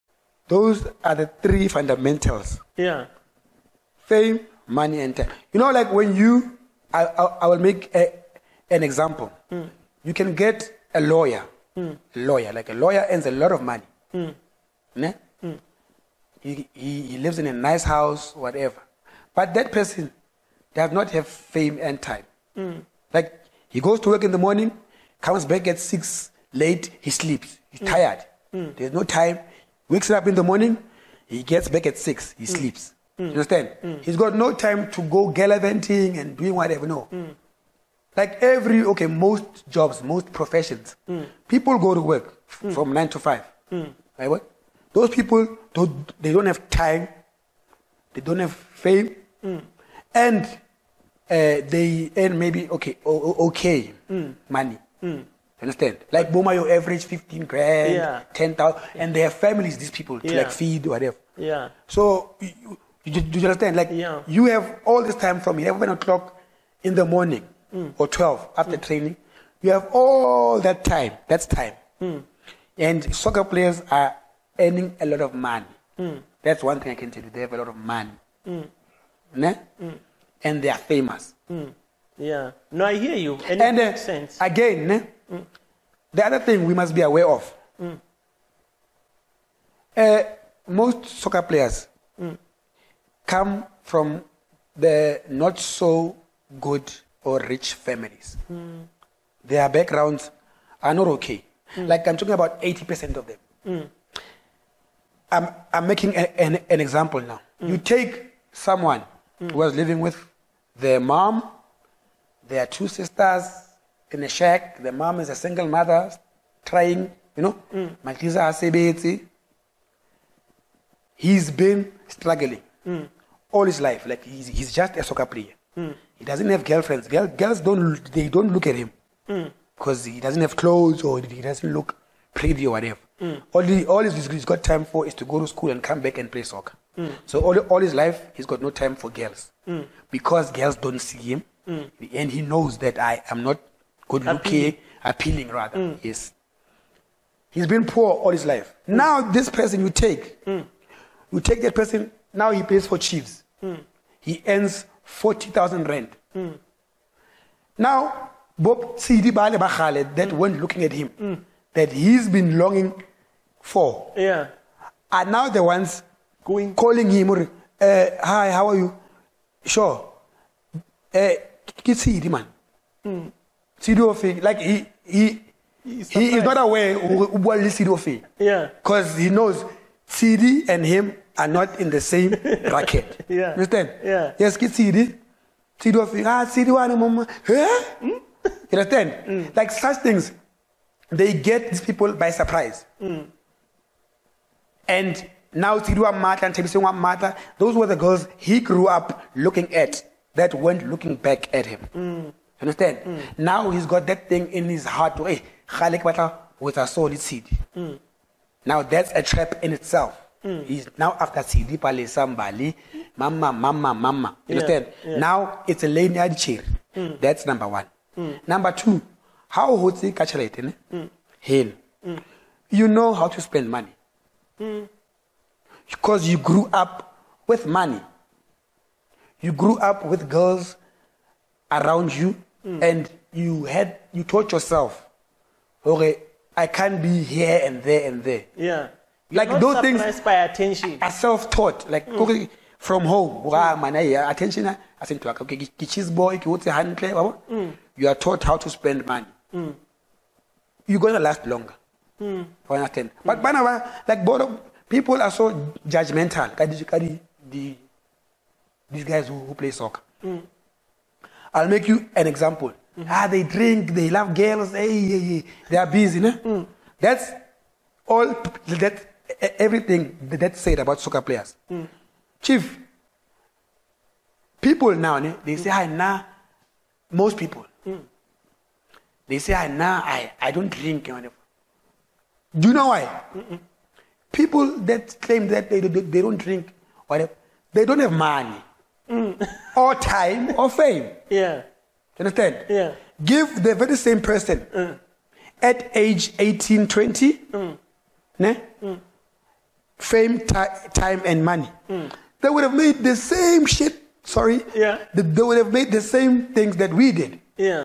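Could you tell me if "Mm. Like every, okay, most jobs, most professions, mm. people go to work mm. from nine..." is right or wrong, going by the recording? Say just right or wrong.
right.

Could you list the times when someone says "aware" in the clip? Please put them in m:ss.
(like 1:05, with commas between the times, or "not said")
1:27, 2:56.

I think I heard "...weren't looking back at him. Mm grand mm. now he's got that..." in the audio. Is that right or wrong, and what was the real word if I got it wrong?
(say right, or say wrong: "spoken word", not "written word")
wrong: "understand", not "grand".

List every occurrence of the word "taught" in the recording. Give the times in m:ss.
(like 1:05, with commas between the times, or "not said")
3:54, 4:01, 4:08.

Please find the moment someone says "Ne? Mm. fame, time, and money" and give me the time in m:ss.
4:58.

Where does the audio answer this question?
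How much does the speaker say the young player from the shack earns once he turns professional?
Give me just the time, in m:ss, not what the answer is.
2:35.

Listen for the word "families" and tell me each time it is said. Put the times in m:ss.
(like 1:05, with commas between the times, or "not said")
0:59, 1:37.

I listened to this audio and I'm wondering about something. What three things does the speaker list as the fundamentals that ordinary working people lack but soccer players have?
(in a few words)
Fame, money, and time.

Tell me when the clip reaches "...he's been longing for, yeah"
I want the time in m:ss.
2:41.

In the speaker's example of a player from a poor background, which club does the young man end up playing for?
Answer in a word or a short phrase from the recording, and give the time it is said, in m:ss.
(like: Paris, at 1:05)
Chiefs, at 2:32.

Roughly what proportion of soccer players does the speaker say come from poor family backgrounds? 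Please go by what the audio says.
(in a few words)
80%.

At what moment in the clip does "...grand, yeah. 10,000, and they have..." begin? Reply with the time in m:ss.
0:57.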